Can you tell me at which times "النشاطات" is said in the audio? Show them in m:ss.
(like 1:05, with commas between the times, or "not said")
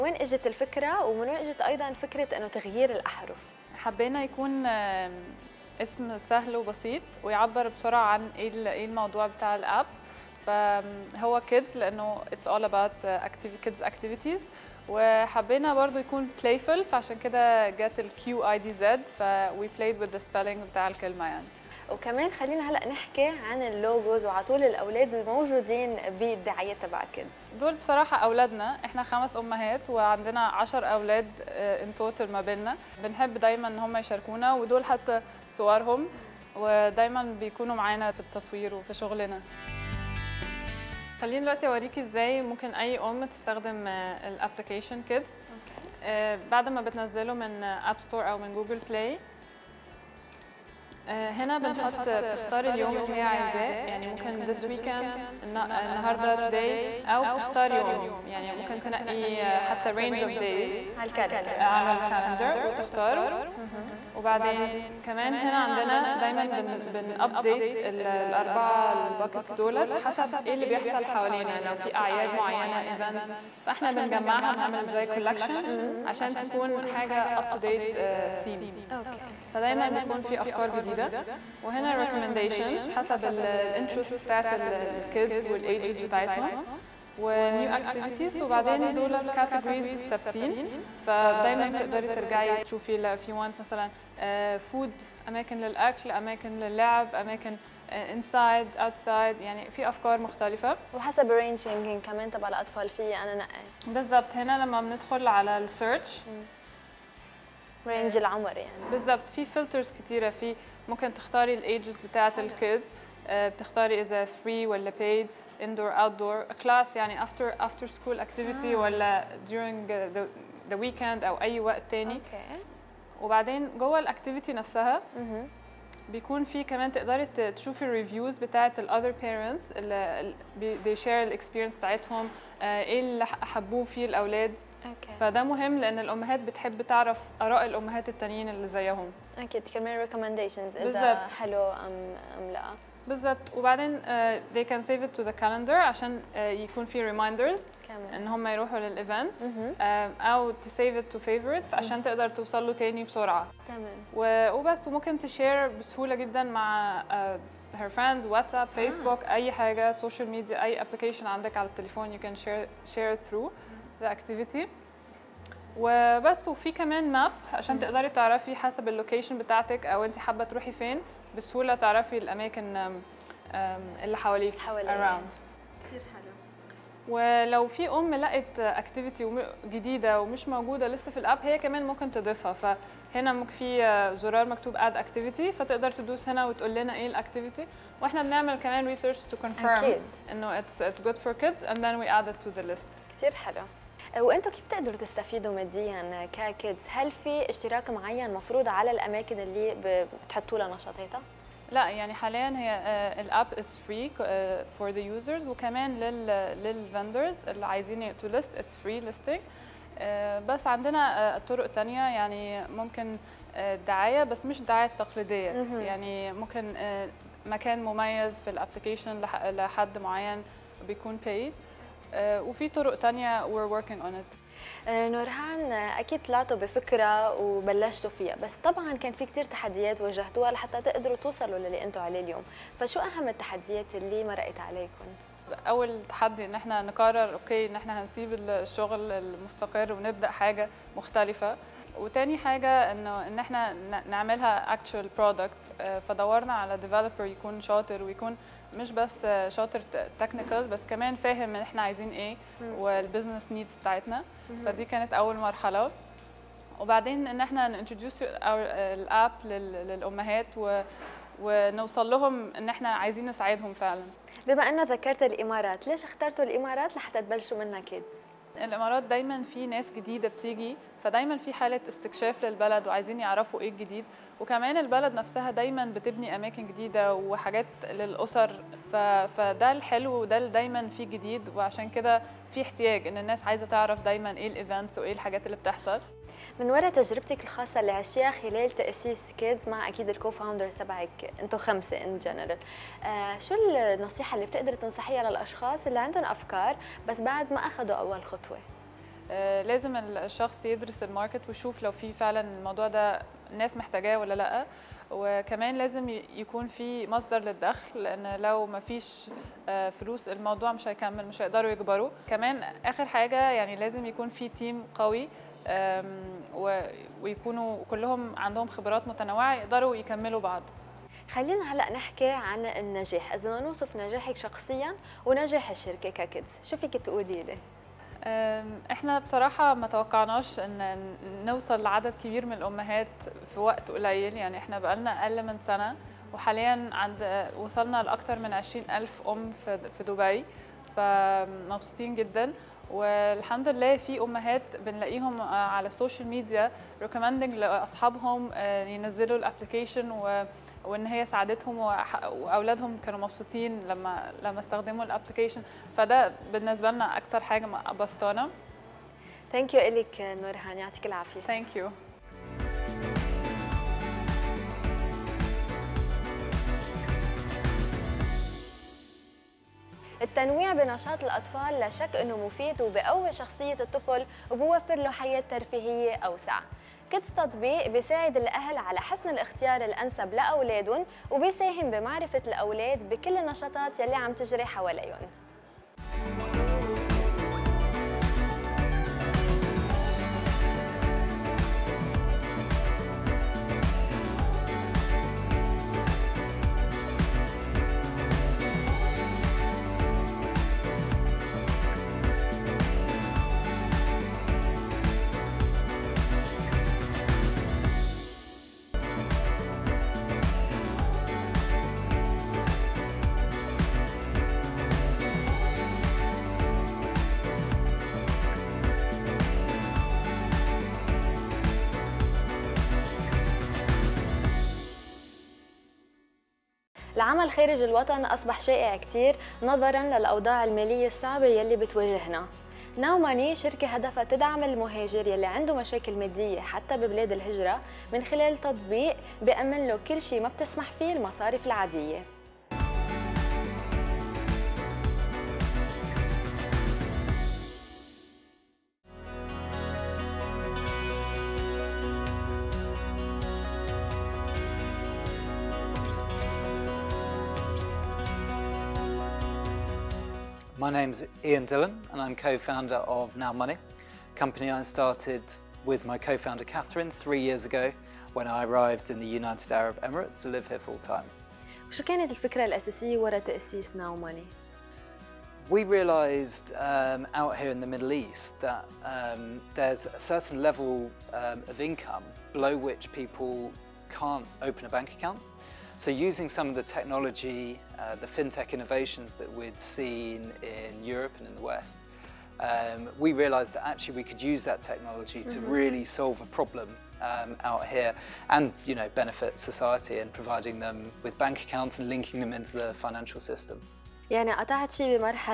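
6:23.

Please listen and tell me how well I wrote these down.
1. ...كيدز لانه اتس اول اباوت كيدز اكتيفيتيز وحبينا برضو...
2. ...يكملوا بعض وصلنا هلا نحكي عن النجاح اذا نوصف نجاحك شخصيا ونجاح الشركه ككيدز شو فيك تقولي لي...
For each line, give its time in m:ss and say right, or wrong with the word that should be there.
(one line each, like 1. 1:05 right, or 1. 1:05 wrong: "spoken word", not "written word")
1. 0:11 right
2. 5:19 wrong: "خلينا", not "وصلنا".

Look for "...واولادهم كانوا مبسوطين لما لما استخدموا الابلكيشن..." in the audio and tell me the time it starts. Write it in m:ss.
5:51.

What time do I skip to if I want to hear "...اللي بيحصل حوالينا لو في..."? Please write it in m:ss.
1:10.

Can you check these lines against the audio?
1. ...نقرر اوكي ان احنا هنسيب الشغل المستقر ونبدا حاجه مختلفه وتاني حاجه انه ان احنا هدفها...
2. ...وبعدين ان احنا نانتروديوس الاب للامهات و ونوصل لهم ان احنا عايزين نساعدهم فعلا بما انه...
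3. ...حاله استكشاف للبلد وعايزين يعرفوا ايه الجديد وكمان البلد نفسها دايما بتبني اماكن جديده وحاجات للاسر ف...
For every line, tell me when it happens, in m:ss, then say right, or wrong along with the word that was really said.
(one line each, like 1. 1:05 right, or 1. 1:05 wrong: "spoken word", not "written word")
1. 3:56 wrong: "نعملها", not "هدفها"
2. 4:16 right
3. 4:31 right.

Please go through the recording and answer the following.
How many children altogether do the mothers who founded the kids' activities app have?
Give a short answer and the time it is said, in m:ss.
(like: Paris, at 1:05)
10, at 0:30.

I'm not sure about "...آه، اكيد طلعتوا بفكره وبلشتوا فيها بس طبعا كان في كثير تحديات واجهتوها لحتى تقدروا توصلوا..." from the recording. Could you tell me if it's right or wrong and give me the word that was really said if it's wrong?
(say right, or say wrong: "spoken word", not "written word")
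right.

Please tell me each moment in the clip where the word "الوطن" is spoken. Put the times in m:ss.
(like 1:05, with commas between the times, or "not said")
7:07.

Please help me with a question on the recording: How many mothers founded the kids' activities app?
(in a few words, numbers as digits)
5.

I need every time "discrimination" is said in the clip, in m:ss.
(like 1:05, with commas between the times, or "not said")
not said.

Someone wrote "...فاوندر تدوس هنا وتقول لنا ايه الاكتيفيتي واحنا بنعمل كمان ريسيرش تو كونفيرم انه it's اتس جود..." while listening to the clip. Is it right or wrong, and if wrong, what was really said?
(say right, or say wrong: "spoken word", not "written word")
wrong: "فتقدر", not "فاوندر".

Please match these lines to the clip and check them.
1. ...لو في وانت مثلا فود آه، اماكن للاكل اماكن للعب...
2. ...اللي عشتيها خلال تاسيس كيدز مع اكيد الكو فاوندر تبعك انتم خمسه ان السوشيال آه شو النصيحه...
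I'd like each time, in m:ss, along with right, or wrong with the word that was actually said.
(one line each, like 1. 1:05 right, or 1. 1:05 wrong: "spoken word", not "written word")
1. 1:32 right
2. 4:47 wrong: "جنرال", not "السوشيال".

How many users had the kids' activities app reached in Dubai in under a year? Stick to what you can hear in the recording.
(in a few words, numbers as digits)
20,000 mothers.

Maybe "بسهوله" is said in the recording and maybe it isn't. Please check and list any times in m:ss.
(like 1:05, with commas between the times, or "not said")
2:35, 2:51.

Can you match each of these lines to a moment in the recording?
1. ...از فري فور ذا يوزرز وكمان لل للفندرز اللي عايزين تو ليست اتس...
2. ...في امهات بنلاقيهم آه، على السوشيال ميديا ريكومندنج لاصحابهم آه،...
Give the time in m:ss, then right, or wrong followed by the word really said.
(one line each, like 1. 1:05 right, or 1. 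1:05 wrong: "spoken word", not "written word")
1. 3:23 right
2. 5:43 right.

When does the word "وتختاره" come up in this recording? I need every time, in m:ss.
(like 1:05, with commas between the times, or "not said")
1:02.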